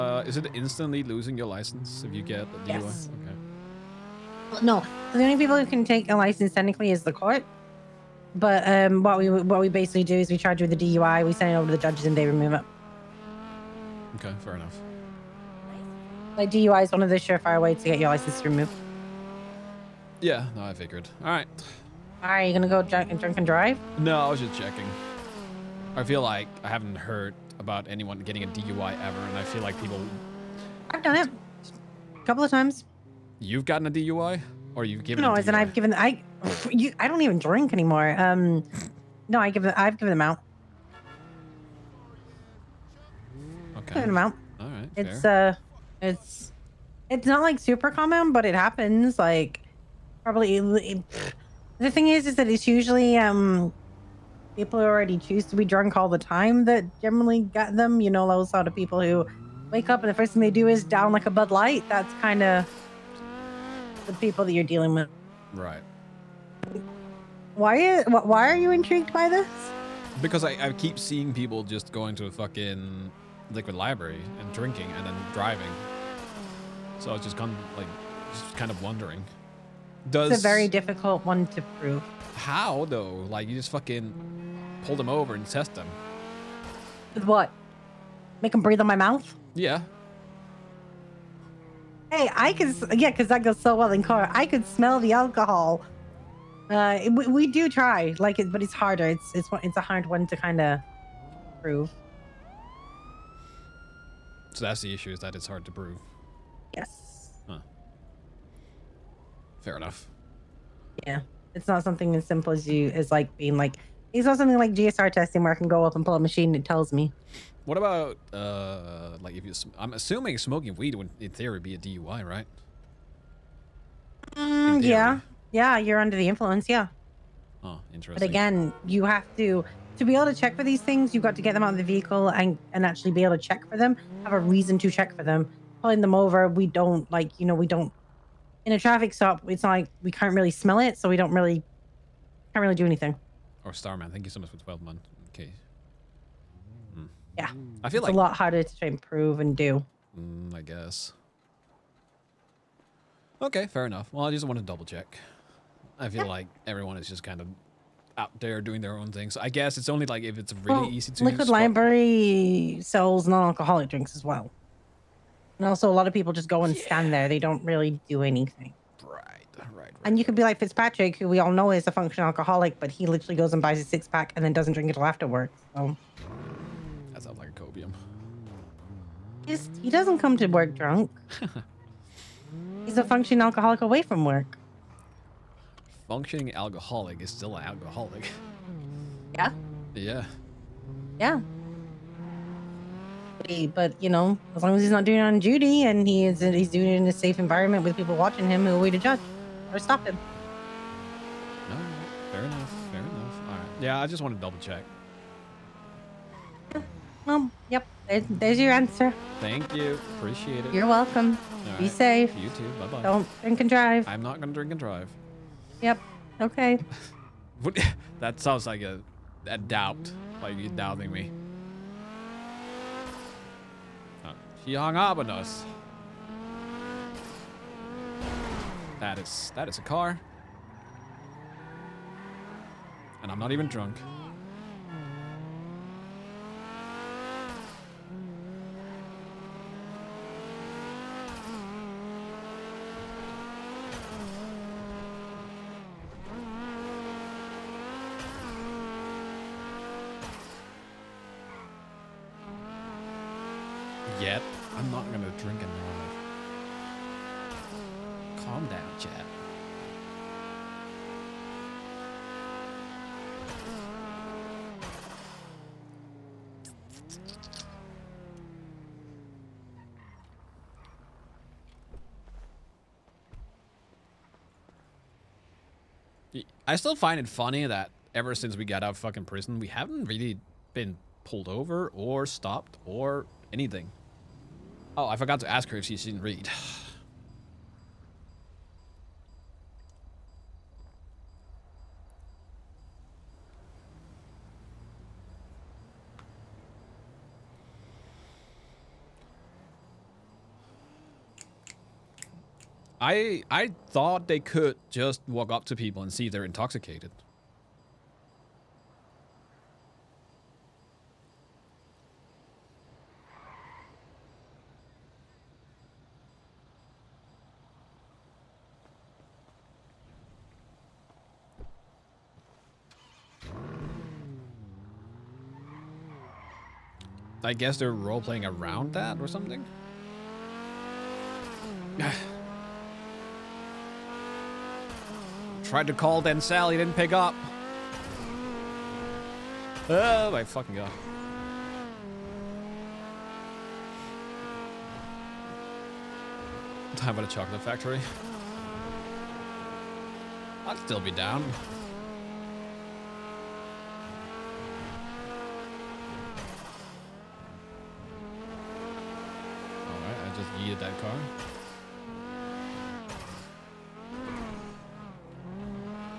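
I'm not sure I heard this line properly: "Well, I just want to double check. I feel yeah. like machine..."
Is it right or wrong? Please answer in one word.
wrong.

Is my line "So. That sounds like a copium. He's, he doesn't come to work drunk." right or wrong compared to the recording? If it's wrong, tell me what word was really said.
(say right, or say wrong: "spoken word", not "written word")
right.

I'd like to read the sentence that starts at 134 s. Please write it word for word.
Have a reason to check for them.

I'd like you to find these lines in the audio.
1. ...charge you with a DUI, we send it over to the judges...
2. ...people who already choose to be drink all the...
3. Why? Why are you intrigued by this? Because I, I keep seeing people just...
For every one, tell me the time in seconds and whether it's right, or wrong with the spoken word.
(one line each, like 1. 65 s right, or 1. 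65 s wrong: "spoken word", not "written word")
1. 10 s right
2. 54 s wrong: "drunk", not "drink"
3. 67 s right.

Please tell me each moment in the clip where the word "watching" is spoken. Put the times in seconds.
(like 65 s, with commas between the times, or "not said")
198 s.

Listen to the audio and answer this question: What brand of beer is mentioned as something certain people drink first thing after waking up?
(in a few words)
Bud Light.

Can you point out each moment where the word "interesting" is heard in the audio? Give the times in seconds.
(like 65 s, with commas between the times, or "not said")
127 s.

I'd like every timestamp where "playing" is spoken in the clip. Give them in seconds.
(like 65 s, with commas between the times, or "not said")
327 s.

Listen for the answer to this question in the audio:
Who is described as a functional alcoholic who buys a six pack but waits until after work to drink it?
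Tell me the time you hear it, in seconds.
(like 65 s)
170 s.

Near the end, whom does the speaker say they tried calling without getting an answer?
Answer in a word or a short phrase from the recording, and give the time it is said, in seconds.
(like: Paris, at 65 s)
Sally, at 336 s.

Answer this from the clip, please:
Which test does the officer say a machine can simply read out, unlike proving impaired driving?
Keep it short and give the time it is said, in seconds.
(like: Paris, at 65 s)
GSR testing, at 114 s.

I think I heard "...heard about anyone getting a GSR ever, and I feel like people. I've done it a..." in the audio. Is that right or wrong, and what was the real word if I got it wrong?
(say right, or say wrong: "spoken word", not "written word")
wrong: "DUI", not "GSR".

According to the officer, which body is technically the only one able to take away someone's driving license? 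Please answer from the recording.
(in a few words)
The court.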